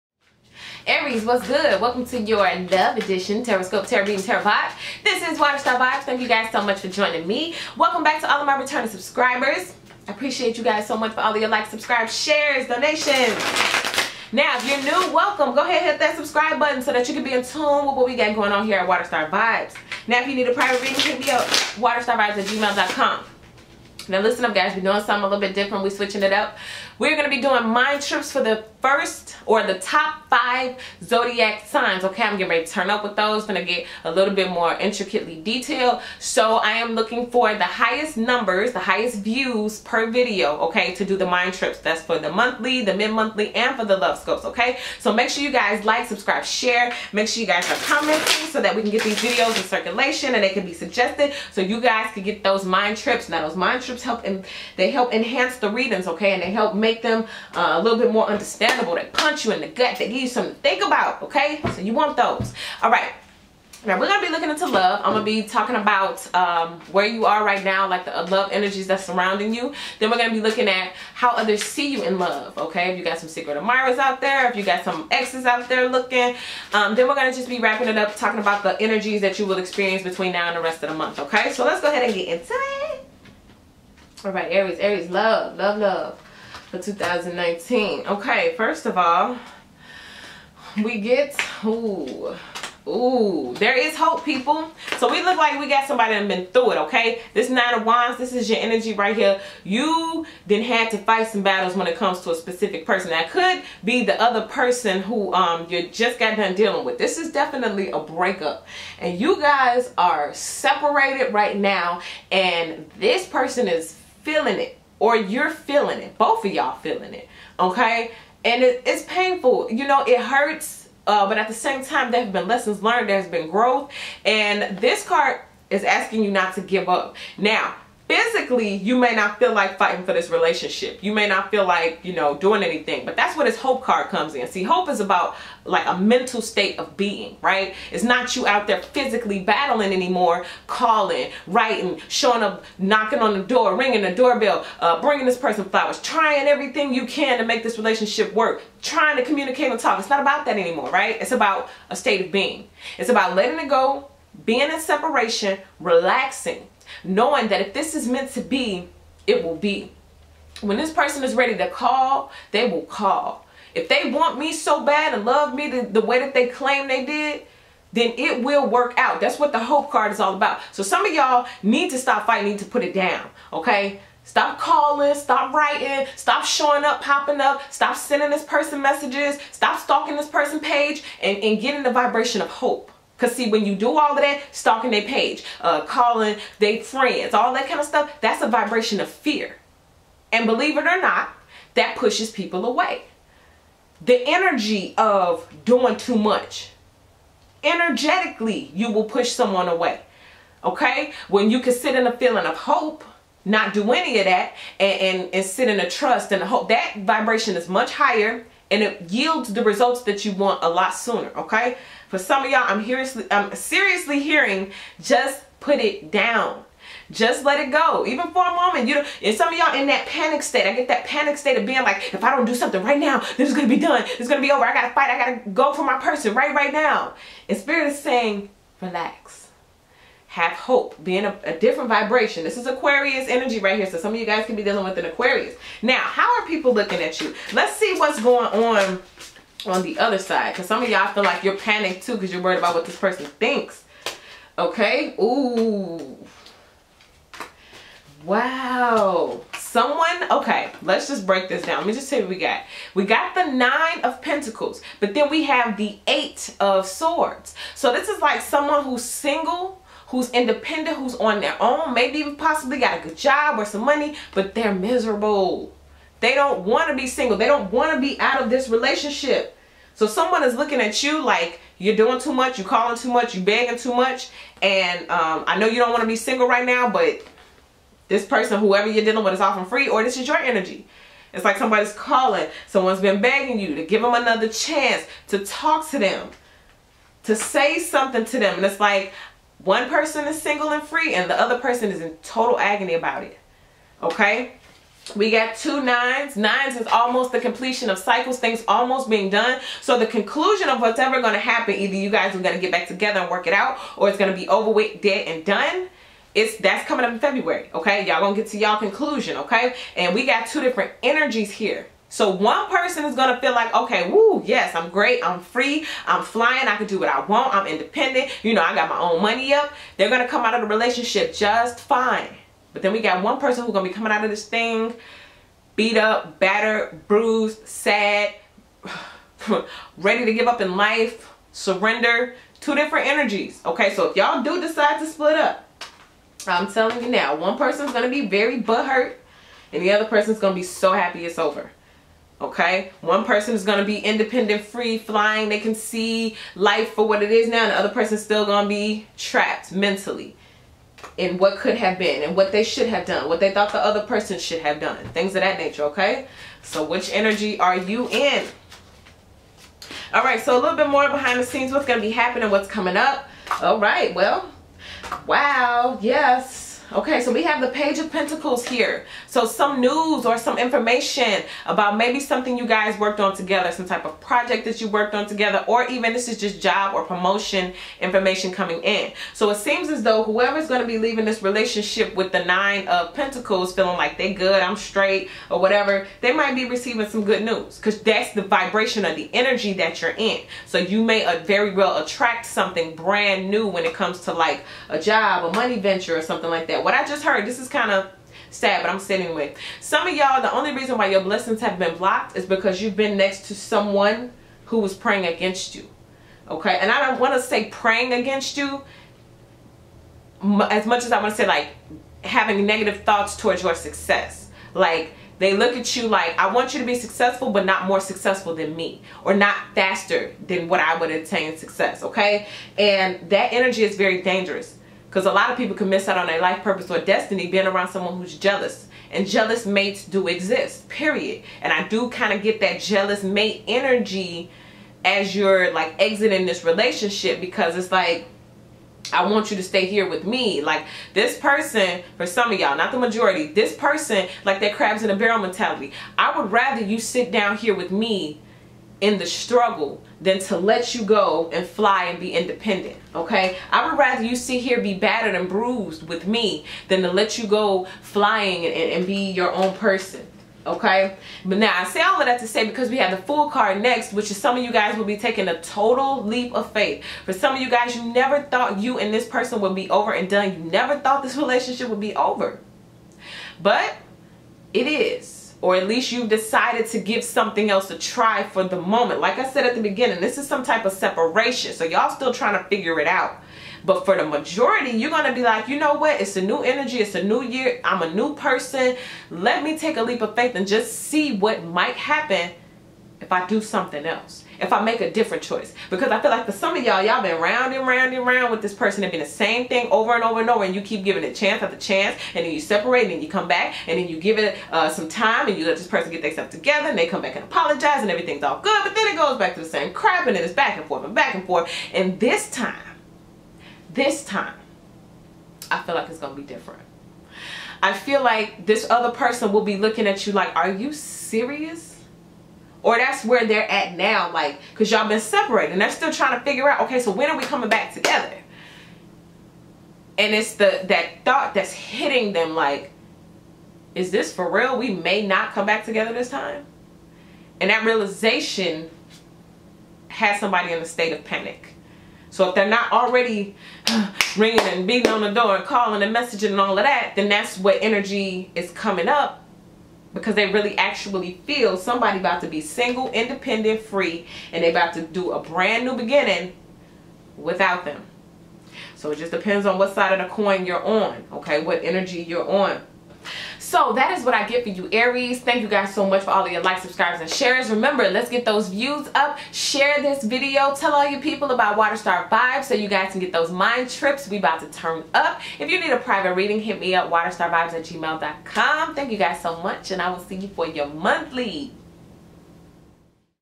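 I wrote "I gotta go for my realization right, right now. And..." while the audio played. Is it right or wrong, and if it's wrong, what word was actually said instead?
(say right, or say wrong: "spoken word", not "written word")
wrong: "person", not "realization".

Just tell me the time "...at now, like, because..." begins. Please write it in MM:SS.
08:43.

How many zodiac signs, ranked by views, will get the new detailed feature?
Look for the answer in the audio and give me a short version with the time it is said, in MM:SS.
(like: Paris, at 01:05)
5, at 00:30.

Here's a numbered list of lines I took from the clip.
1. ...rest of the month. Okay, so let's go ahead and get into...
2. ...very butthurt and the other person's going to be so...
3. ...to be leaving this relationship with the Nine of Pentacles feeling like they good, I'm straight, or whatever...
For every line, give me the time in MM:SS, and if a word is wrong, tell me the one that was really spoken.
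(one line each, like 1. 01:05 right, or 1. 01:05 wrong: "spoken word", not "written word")
1. 01:20 right
2. 05:38 right
3. 06:20 right.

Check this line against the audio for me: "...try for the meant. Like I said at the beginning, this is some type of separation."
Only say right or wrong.
wrong.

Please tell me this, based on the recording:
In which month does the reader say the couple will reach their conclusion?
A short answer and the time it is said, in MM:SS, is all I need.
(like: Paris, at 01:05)
February, at 05:07.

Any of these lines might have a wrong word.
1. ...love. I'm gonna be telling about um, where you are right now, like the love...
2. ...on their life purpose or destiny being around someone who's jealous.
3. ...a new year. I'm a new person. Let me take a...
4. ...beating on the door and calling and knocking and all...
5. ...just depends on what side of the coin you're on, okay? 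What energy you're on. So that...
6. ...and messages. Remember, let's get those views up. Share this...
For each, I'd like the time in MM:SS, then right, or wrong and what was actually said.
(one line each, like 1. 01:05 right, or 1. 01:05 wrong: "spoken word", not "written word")
1. 01:04 wrong: "talking", not "telling"
2. 07:06 right
3. 08:07 right
4. 09:04 wrong: "messaging", not "knocking"
5. 09:19 right
6. 09:27 wrong: "shares", not "messages".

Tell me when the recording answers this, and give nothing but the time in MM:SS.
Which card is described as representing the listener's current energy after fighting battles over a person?
01:37.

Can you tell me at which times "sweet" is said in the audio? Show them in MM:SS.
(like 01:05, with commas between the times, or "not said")
not said.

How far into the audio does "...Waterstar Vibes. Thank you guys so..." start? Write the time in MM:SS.
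00:05.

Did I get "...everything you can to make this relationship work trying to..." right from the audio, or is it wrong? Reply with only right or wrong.
right.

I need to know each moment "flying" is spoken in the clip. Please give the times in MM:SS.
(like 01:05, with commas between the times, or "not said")
05:16, 05:44, 07:38.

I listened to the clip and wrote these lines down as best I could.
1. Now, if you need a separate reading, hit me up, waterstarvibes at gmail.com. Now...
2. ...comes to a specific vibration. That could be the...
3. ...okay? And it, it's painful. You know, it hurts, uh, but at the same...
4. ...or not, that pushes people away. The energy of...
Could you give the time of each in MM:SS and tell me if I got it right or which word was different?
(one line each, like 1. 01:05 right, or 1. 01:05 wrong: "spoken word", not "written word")
1. 00:20 wrong: "private", not "separate"
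2. 01:41 wrong: "person", not "vibration"
3. 01:57 right
4. 03:10 right.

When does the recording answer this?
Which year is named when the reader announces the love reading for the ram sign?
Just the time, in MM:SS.
01:26.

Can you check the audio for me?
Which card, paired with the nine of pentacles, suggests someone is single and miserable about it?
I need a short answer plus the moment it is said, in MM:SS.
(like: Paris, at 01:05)
eight of swords, at 04:16.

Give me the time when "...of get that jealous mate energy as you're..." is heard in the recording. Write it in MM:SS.
07:12.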